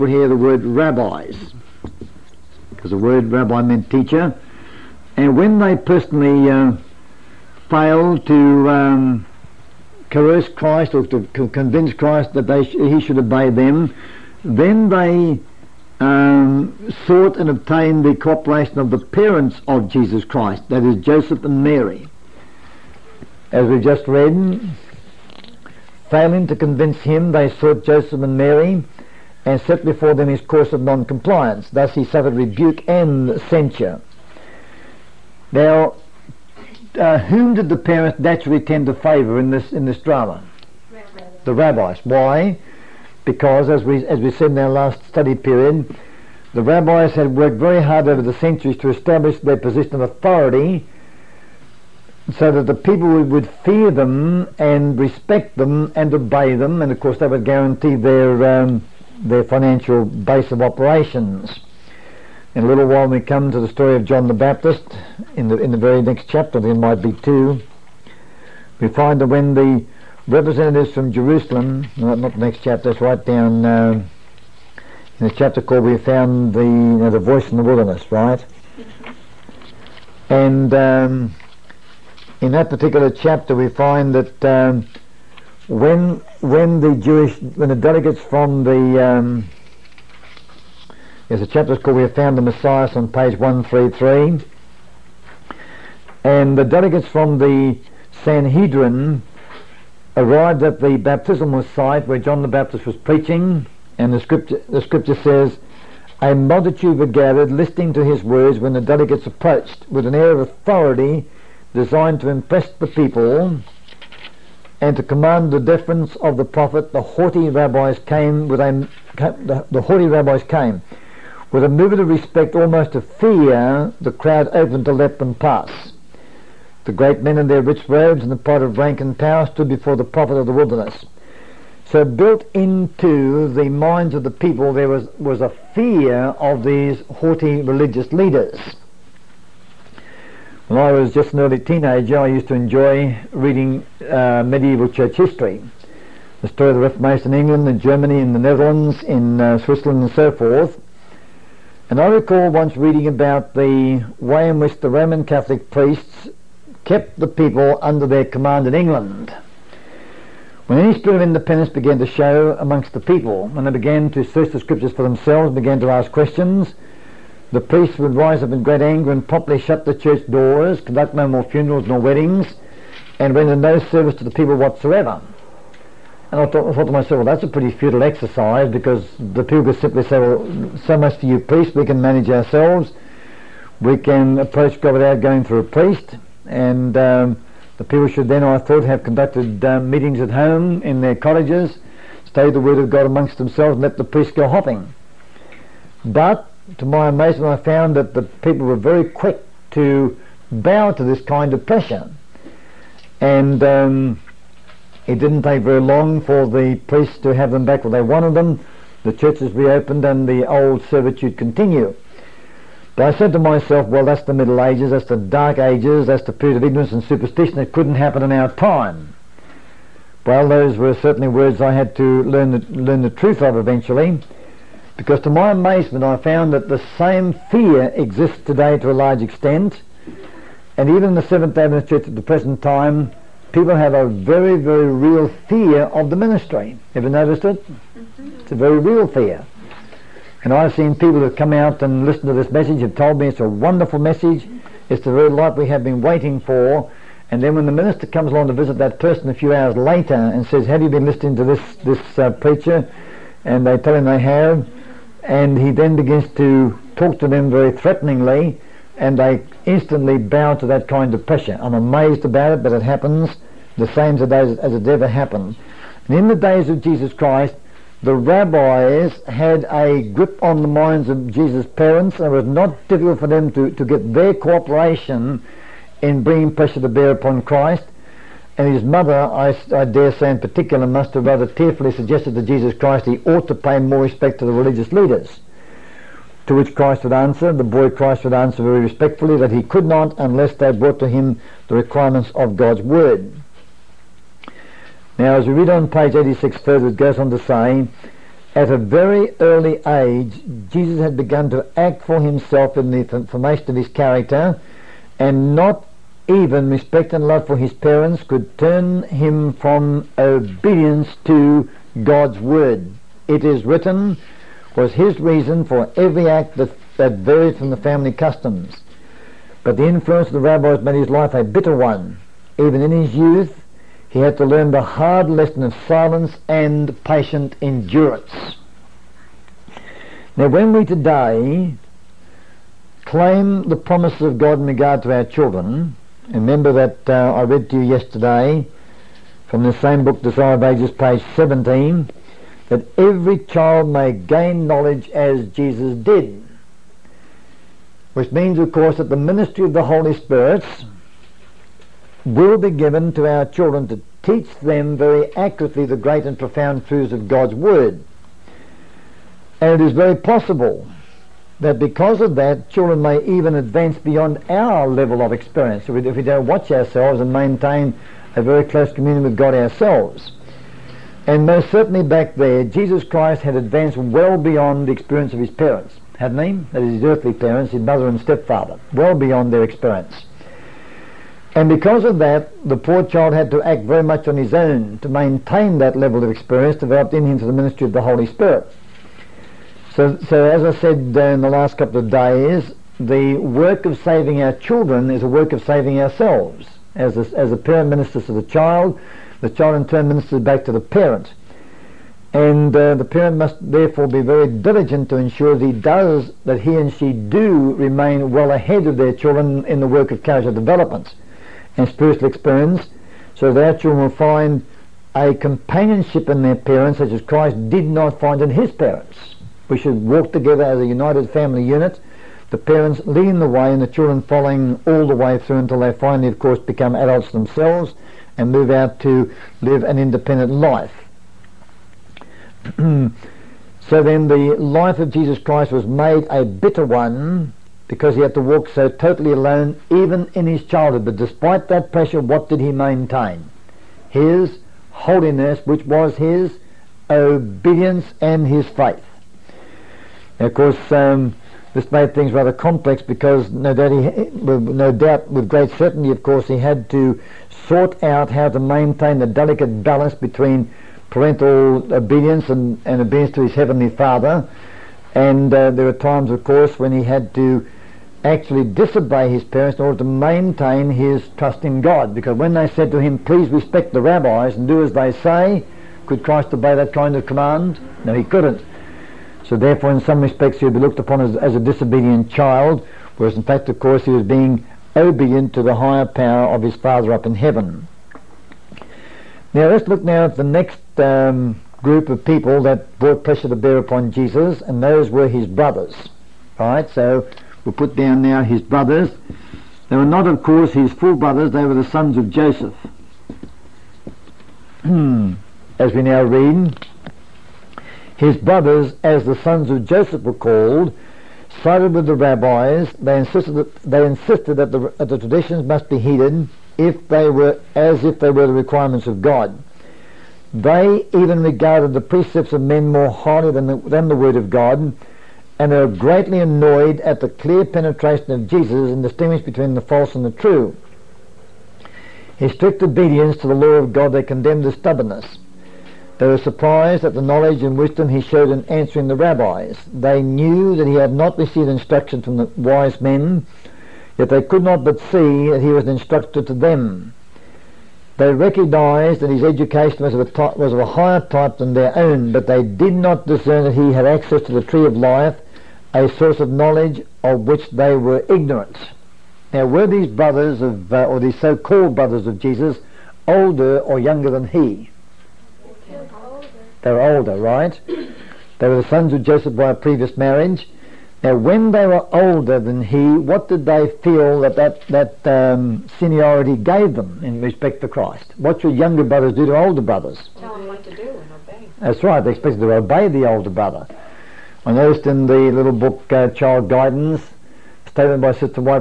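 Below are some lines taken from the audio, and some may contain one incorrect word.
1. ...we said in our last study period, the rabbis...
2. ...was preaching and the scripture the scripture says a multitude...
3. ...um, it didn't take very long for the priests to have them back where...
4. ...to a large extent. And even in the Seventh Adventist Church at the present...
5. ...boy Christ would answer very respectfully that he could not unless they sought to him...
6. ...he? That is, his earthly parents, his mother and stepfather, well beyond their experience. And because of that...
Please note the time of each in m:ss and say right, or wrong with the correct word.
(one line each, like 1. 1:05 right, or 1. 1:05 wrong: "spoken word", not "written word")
1. 0:44 right
2. 1:42 right
3. 3:23 right
4. 3:48 right
5. 4:47 wrong: "brought", not "sought"
6. 6:16 right.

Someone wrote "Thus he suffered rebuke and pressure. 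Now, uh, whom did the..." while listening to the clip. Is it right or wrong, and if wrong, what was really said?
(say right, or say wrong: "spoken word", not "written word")
wrong: "censure", not "pressure".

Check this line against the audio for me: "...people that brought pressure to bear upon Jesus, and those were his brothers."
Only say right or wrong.
right.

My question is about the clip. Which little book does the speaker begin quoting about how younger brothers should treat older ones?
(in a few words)
Child Guidance.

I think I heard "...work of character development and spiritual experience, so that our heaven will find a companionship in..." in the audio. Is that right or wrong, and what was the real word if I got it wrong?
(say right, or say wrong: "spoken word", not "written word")
wrong: "children", not "heaven".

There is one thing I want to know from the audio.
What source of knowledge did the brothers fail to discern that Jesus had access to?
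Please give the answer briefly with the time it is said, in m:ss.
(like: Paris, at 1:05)
the tree of life, at 9:14.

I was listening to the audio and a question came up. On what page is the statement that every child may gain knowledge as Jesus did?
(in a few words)
17.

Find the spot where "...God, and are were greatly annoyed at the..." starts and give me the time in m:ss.
8:44.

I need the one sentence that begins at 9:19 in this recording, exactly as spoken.
Now, were these brothers of, uh, or these so-called brothers of Jesus, older or younger than he?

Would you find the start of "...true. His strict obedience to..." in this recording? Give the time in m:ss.
8:50.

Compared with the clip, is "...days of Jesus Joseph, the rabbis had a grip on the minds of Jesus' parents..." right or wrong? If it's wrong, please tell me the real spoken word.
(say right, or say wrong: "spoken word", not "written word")
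wrong: "Christ", not "Joseph".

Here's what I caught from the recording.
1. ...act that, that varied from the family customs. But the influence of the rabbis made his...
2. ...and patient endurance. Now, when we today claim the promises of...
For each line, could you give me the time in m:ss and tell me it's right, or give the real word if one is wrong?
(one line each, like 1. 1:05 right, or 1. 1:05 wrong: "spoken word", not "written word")
1. 5:16 right
2. 5:26 right.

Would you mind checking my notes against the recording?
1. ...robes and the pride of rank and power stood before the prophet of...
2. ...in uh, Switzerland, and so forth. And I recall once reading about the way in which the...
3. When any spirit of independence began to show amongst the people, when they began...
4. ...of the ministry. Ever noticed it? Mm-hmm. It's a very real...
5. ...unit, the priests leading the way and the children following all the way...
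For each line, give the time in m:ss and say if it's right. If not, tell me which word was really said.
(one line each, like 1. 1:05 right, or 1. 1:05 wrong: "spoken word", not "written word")
1. 2:07 right
2. 2:29 right
3. 2:40 right
4. 3:55 right
5. 7:01 wrong: "parents", not "priests".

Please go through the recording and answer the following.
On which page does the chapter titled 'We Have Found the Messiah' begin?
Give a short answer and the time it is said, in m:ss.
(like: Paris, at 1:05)
133, at 1:33.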